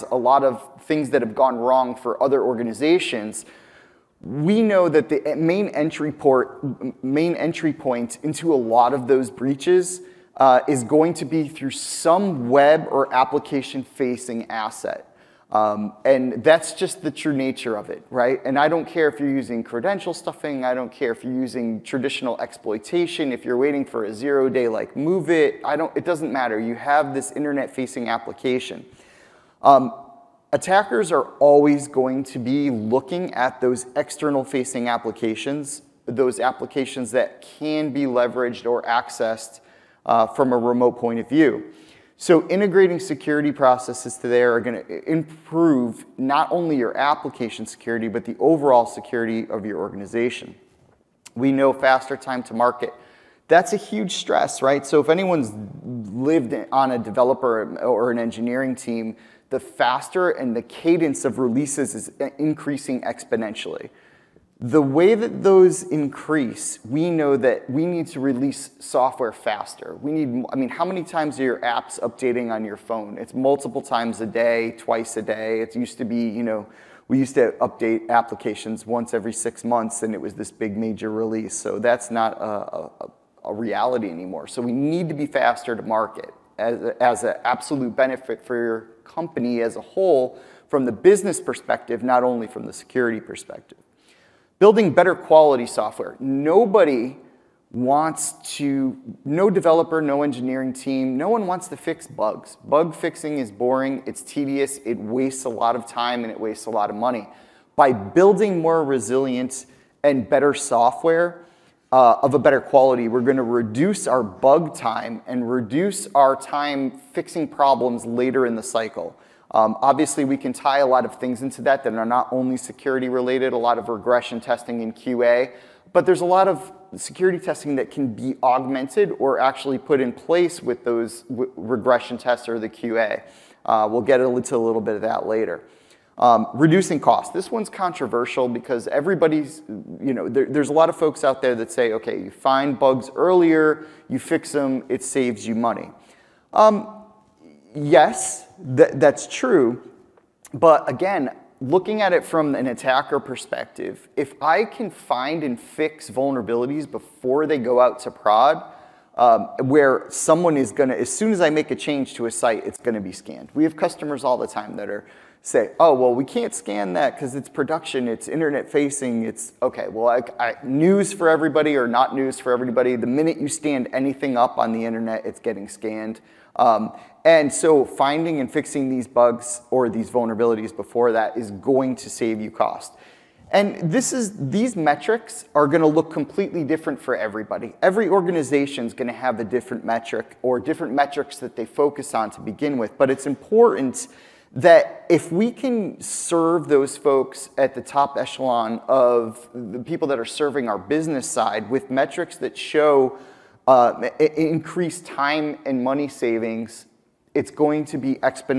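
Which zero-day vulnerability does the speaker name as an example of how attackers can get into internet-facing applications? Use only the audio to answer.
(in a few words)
MOVEit.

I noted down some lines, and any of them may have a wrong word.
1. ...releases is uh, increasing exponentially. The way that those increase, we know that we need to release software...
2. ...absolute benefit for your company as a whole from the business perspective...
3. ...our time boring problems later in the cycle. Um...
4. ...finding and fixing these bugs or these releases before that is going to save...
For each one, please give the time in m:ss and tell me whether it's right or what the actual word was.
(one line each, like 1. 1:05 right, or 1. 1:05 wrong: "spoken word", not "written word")
1. 1:01 right
2. 1:27 right
3. 1:56 wrong: "fixing", not "boring"
4. 2:57 wrong: "vulnerabilities", not "releases".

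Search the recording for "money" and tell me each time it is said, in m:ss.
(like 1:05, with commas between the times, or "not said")
1:46, 2:25, 3:25.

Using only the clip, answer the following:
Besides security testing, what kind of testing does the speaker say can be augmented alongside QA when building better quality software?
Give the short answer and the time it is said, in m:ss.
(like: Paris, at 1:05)
regression testing, at 2:03.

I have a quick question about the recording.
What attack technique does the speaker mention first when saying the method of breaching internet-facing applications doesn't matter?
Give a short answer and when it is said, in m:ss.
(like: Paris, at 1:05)
credential stuffing, at 0:19.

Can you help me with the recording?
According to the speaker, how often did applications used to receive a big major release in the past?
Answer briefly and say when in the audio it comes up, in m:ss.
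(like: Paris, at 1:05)
once every six months, at 1:18.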